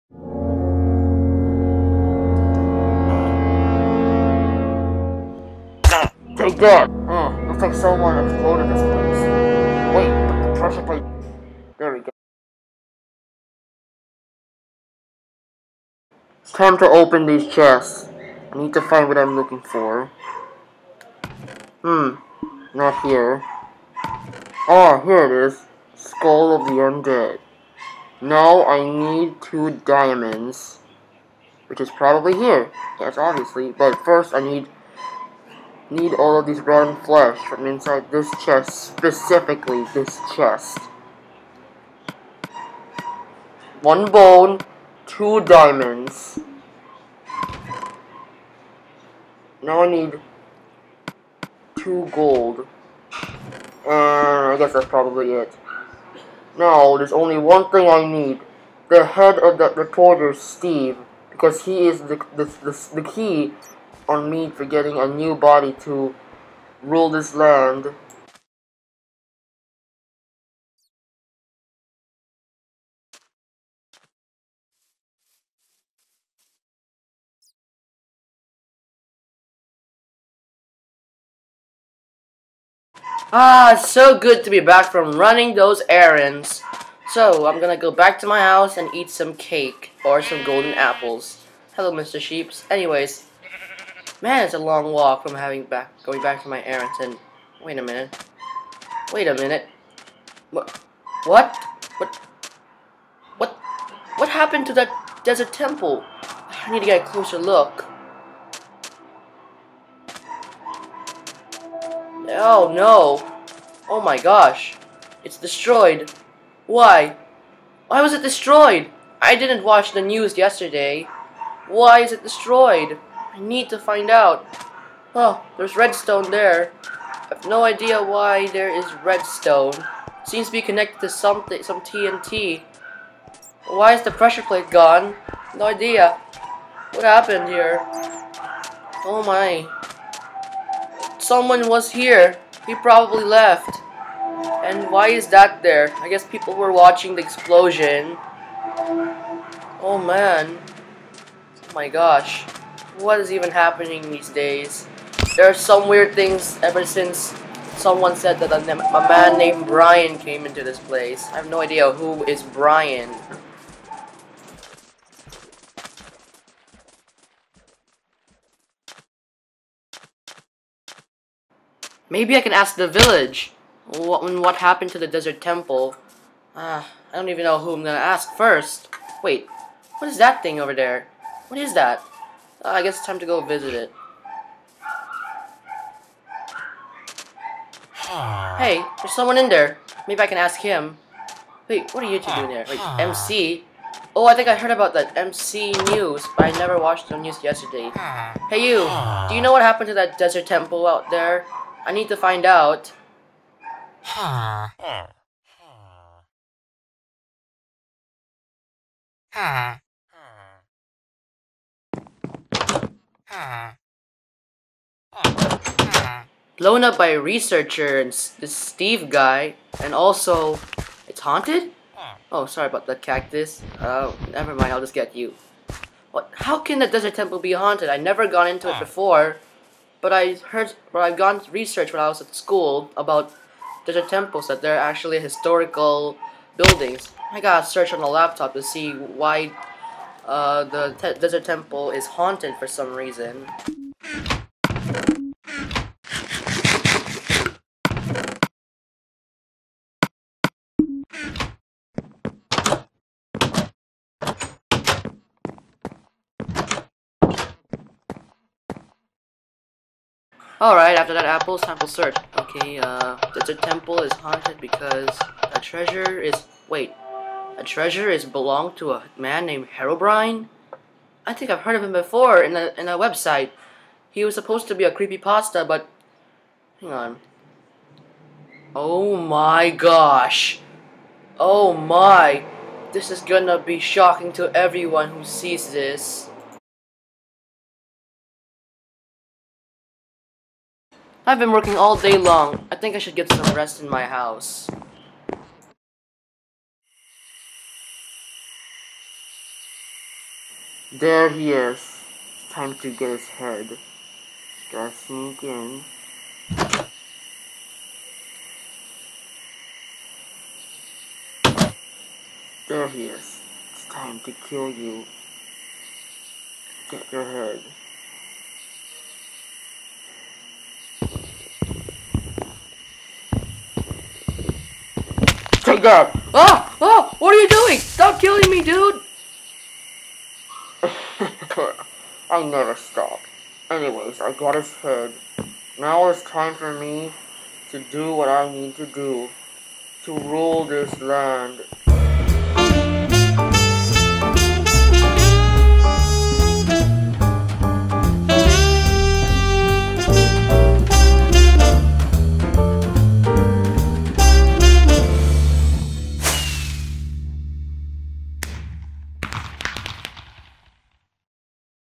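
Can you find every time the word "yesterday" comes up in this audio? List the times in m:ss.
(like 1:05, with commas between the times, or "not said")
2:00, 3:17.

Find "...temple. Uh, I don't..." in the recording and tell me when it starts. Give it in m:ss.
2:55.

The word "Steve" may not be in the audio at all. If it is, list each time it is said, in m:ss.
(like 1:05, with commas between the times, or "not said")
1:00, 3:38.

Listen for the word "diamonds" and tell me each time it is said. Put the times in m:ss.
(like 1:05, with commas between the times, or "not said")
0:29, 0:45.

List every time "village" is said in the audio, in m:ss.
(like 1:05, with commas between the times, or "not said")
2:52.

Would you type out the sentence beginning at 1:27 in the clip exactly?
So, I'm gonna go back to my house and eat some cake or some golden apples.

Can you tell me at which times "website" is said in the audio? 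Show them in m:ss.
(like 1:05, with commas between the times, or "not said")
4:32.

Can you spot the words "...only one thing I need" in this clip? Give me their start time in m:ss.
0:57.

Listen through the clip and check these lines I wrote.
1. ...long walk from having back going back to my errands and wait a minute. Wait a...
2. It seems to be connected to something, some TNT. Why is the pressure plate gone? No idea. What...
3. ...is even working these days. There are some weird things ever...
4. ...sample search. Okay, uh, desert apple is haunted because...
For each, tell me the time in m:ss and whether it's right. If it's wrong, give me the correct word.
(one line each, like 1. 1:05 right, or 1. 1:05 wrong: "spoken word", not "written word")
1. 1:34 right
2. 2:09 right
3. 2:33 wrong: "happening", not "working"
4. 4:21 wrong: "temple", not "apple".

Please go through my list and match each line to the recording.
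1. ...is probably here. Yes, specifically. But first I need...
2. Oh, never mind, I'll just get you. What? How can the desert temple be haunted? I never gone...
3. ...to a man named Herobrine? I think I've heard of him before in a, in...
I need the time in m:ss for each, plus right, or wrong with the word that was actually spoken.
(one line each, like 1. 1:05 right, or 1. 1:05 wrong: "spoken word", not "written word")
1. 0:31 wrong: "obviously", not "specifically"
2. 3:43 right
3. 4:28 right.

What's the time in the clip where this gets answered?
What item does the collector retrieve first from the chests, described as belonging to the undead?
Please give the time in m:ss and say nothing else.
0:25.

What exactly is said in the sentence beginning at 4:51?
I've been working all day long.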